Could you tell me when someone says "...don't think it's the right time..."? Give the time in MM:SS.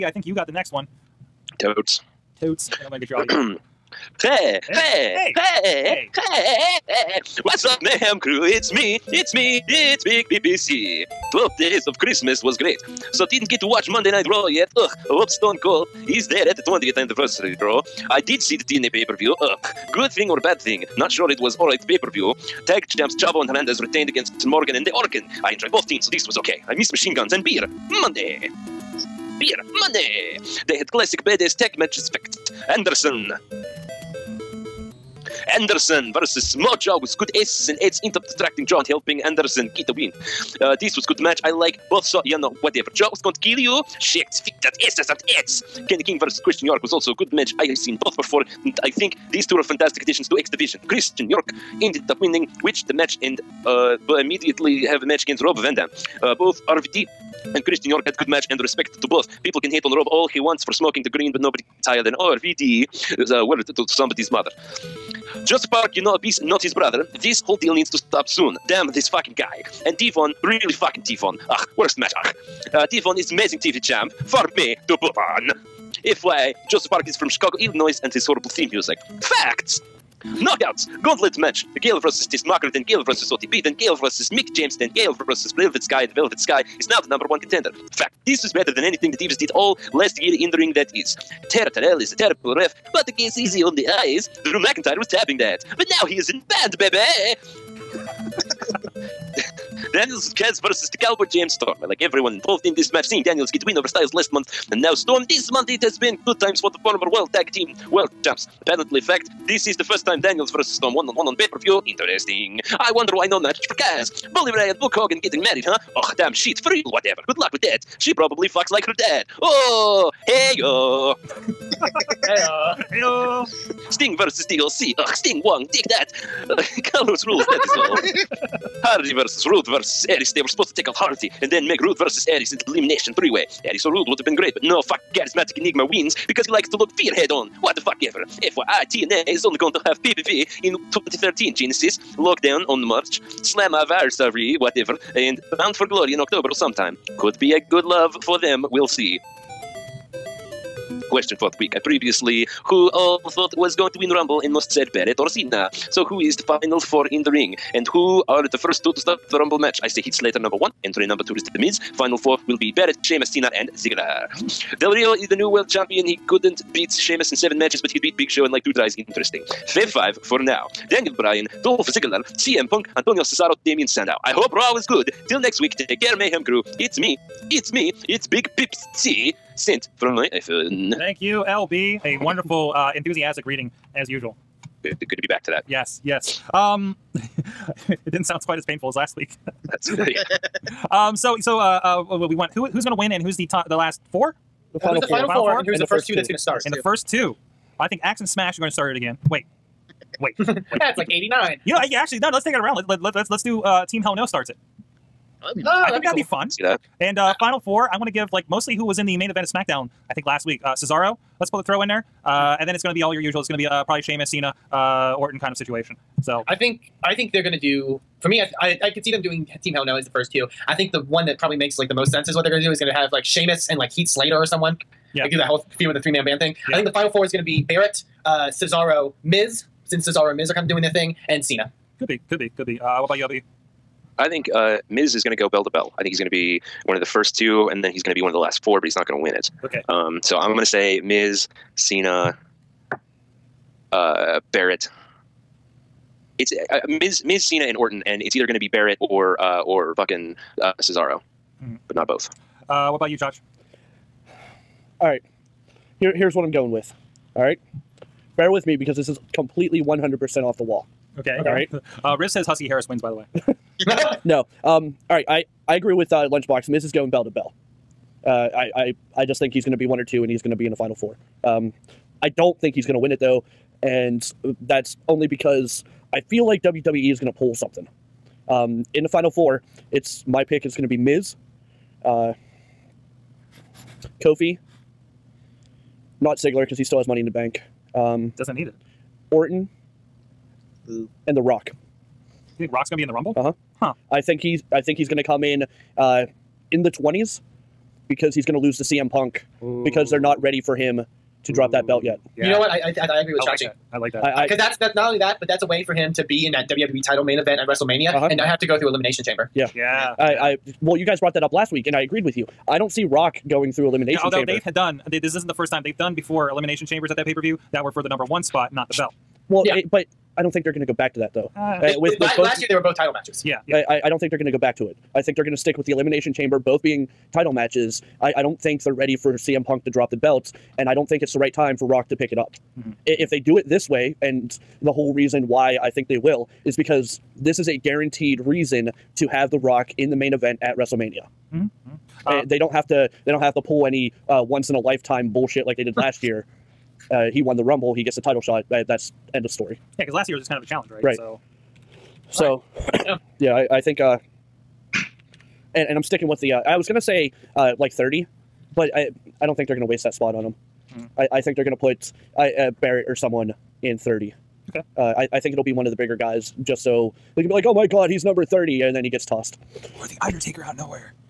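05:30.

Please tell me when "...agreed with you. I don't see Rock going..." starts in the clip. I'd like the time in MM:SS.
05:12.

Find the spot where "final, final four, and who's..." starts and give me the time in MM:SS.
03:15.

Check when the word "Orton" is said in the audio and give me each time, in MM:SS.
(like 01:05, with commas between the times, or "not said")
03:35, 04:07, 04:49.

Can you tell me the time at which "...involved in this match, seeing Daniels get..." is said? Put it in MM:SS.
01:42.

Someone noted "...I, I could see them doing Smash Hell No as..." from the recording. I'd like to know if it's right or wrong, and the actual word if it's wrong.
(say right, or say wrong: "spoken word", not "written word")
wrong: "Team", not "Smash".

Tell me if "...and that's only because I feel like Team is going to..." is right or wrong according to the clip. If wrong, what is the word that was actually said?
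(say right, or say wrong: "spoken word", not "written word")
wrong: "WWE", not "Team".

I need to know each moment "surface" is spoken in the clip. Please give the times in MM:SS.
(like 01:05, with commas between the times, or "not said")
not said.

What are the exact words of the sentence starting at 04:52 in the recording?
You think Rock's gonna be in the Rumble?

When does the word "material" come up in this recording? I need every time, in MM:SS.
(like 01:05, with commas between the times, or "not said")
not said.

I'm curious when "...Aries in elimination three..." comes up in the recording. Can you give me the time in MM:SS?
02:12.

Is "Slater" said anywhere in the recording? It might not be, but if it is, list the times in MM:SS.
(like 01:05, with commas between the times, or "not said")
02:40, 03:44.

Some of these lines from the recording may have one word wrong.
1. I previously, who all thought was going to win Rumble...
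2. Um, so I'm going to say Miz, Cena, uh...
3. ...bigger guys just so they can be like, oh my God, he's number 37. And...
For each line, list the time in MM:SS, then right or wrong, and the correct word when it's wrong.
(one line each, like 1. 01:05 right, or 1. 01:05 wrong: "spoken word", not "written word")
1. 02:31 right
2. 03:59 right
3. 06:05 wrong: "30", not "37".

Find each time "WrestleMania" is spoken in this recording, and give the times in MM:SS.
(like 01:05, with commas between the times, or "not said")
05:07, 05:40.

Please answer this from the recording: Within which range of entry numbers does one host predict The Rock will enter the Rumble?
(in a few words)
The twenties.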